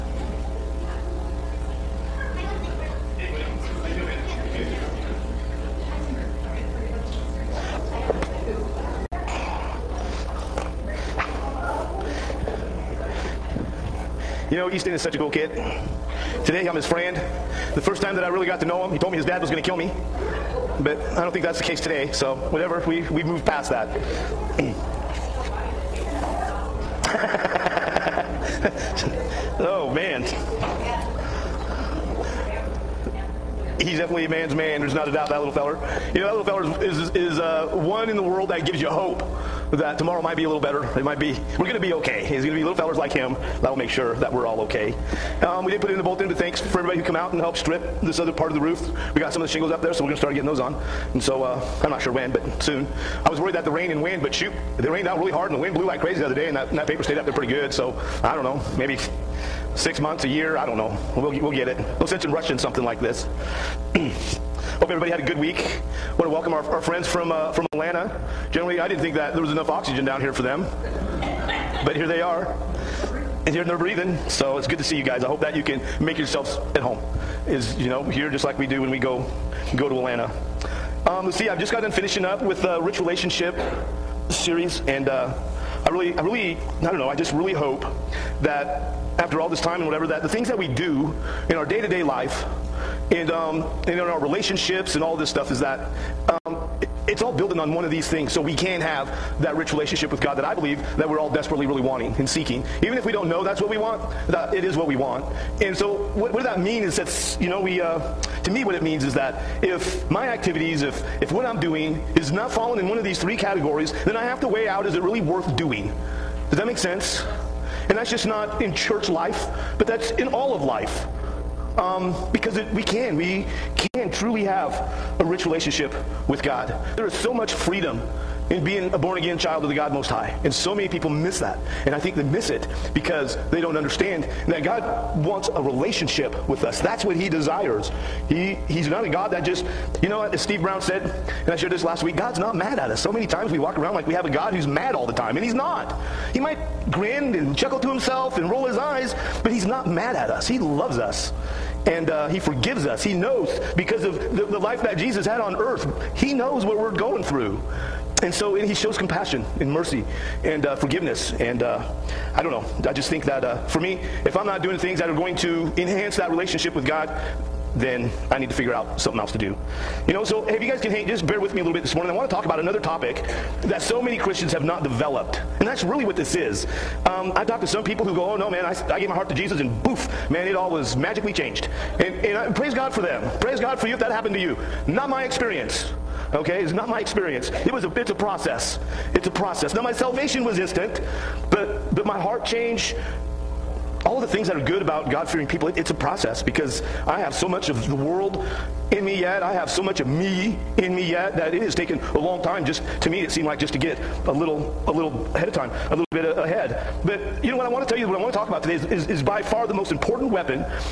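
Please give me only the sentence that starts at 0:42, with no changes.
It's going to be little fellers like him that'll make sure that we're all okay.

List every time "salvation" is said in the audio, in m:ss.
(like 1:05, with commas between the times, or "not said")
3:09.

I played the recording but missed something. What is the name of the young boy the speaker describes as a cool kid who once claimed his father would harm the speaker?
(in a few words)
Easton.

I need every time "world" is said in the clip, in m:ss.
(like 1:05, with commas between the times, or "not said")
0:38, 3:17.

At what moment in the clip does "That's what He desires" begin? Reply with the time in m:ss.
2:16.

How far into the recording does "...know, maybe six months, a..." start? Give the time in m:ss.
0:58.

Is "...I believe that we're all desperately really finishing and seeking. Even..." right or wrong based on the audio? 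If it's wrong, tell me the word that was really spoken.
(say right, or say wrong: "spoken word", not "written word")
wrong: "wanting", not "finishing".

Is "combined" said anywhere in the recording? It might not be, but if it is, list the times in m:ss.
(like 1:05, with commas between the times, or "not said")
not said.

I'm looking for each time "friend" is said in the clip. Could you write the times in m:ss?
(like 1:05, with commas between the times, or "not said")
0:16, 1:06.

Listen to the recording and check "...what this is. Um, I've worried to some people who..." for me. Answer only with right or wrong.
wrong.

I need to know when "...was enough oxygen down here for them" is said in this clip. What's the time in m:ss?
1:09.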